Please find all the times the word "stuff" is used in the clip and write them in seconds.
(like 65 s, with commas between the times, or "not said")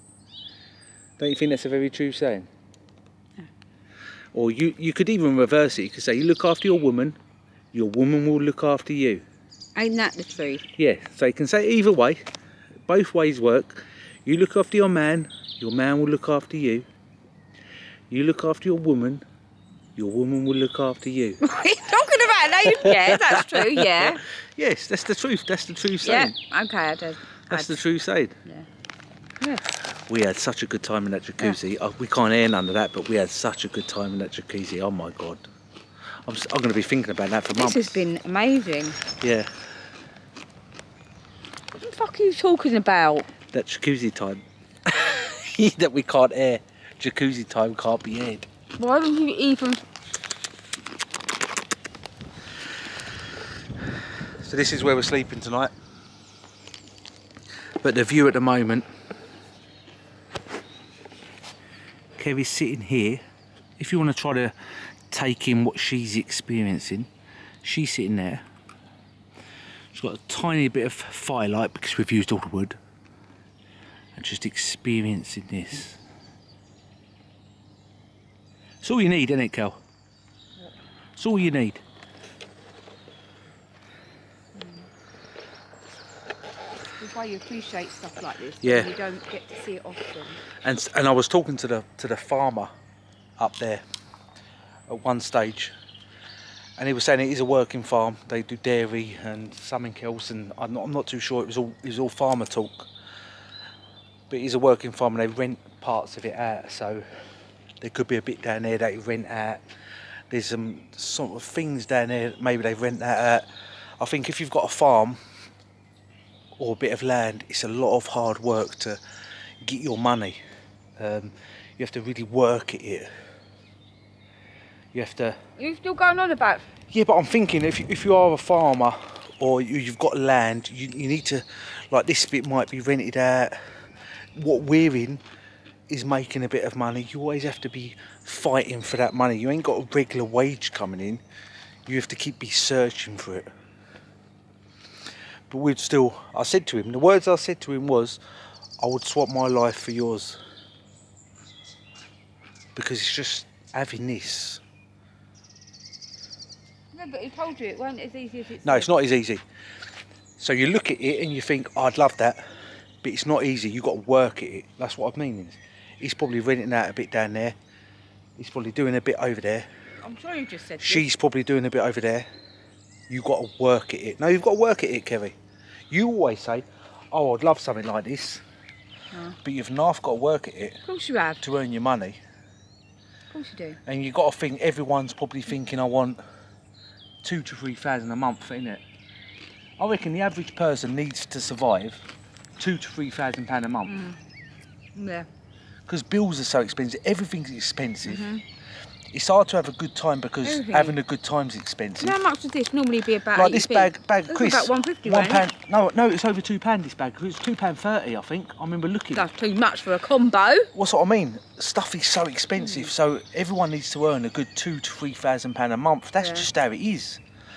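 87 s, 211 s.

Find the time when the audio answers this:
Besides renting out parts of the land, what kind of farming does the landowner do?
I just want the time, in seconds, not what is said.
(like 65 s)
98 s.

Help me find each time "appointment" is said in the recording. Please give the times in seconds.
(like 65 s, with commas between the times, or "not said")
not said.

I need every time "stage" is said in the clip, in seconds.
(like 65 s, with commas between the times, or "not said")
95 s.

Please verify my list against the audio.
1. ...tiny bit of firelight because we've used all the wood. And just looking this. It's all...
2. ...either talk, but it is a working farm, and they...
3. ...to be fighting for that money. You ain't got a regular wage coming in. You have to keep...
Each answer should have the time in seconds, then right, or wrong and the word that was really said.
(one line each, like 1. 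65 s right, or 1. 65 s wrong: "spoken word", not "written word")
1. 70 s wrong: "experiencing", not "looking"
2. 102 s wrong: "farmer", not "either"
3. 137 s right.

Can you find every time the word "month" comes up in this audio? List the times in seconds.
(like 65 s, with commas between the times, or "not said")
37 s, 188 s, 193 s, 215 s.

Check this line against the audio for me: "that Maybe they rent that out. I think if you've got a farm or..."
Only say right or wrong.
right.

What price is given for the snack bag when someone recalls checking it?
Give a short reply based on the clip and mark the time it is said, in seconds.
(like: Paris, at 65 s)
£2.30, at 207 s.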